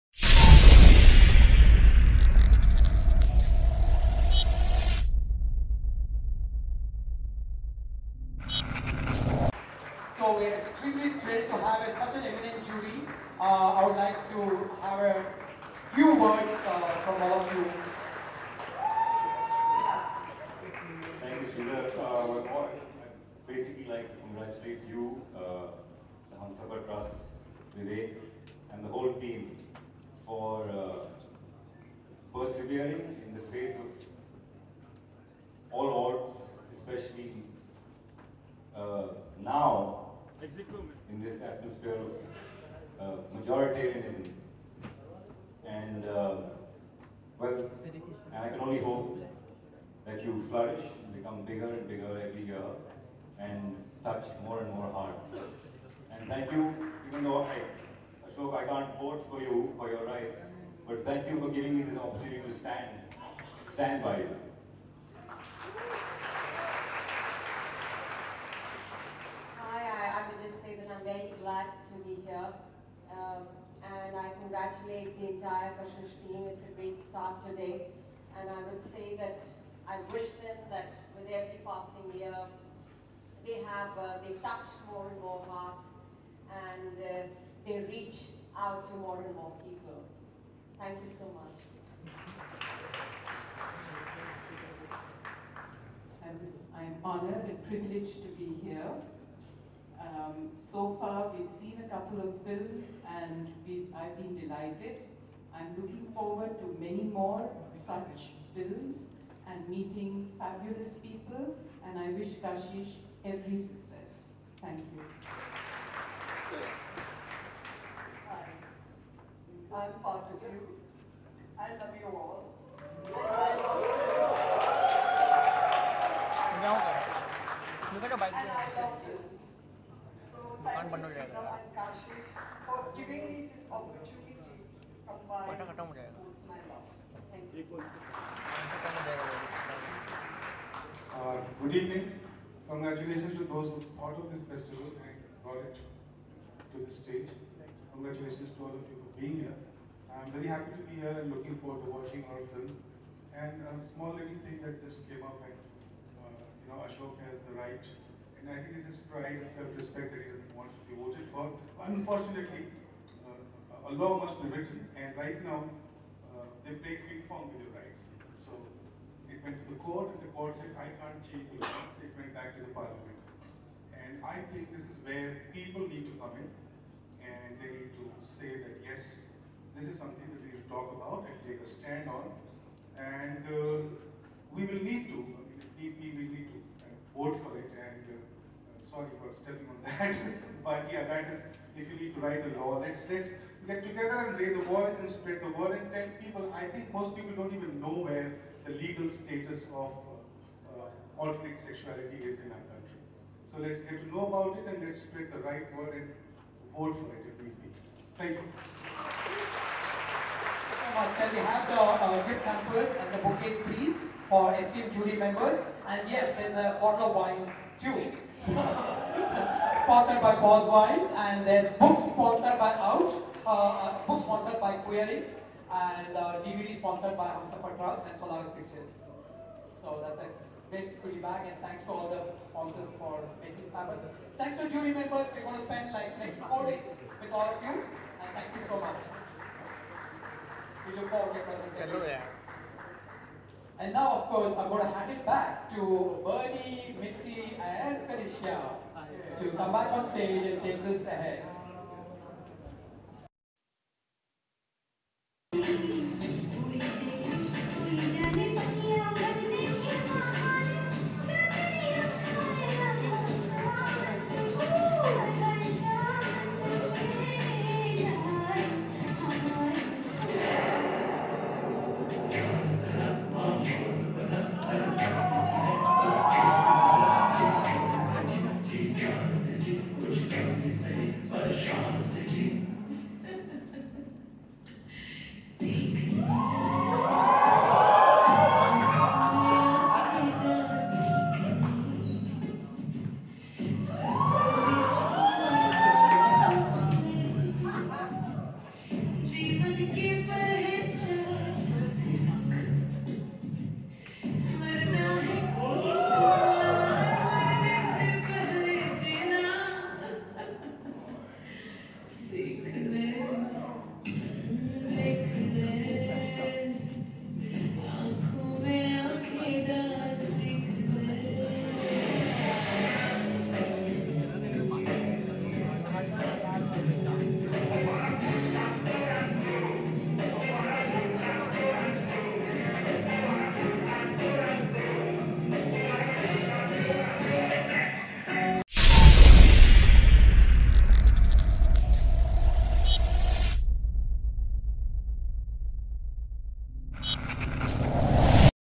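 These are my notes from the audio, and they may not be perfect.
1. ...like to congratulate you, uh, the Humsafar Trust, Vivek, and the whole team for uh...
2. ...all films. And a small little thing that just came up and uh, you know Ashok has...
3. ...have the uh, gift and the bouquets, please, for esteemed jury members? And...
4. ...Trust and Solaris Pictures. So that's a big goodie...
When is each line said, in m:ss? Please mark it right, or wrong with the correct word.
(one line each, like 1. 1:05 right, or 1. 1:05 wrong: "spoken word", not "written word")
1. 0:23 right
2. 2:32 right
3. 3:31 right
4. 3:47 right.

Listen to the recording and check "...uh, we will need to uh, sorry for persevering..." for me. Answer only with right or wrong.
wrong.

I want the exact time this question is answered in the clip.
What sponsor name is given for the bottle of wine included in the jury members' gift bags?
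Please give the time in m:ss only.
3:40.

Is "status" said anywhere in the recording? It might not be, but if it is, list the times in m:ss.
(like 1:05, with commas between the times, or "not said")
3:19.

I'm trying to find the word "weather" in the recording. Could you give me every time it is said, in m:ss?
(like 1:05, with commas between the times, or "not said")
not said.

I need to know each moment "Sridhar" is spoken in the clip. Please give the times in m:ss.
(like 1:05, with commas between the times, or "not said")
0:21.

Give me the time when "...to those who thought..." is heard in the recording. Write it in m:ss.
2:23.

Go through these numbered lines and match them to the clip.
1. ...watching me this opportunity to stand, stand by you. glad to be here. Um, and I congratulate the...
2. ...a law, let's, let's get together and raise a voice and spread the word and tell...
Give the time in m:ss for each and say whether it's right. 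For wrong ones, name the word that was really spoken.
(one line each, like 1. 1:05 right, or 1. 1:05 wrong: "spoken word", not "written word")
1. 1:01 wrong: "giving", not "watching"
2. 3:12 right.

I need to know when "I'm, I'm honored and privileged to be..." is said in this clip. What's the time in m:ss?
1:36.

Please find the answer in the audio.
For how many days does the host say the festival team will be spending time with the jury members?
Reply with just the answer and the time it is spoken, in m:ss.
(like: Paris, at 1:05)
4, at 3:56.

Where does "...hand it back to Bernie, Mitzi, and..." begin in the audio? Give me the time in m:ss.
4:04.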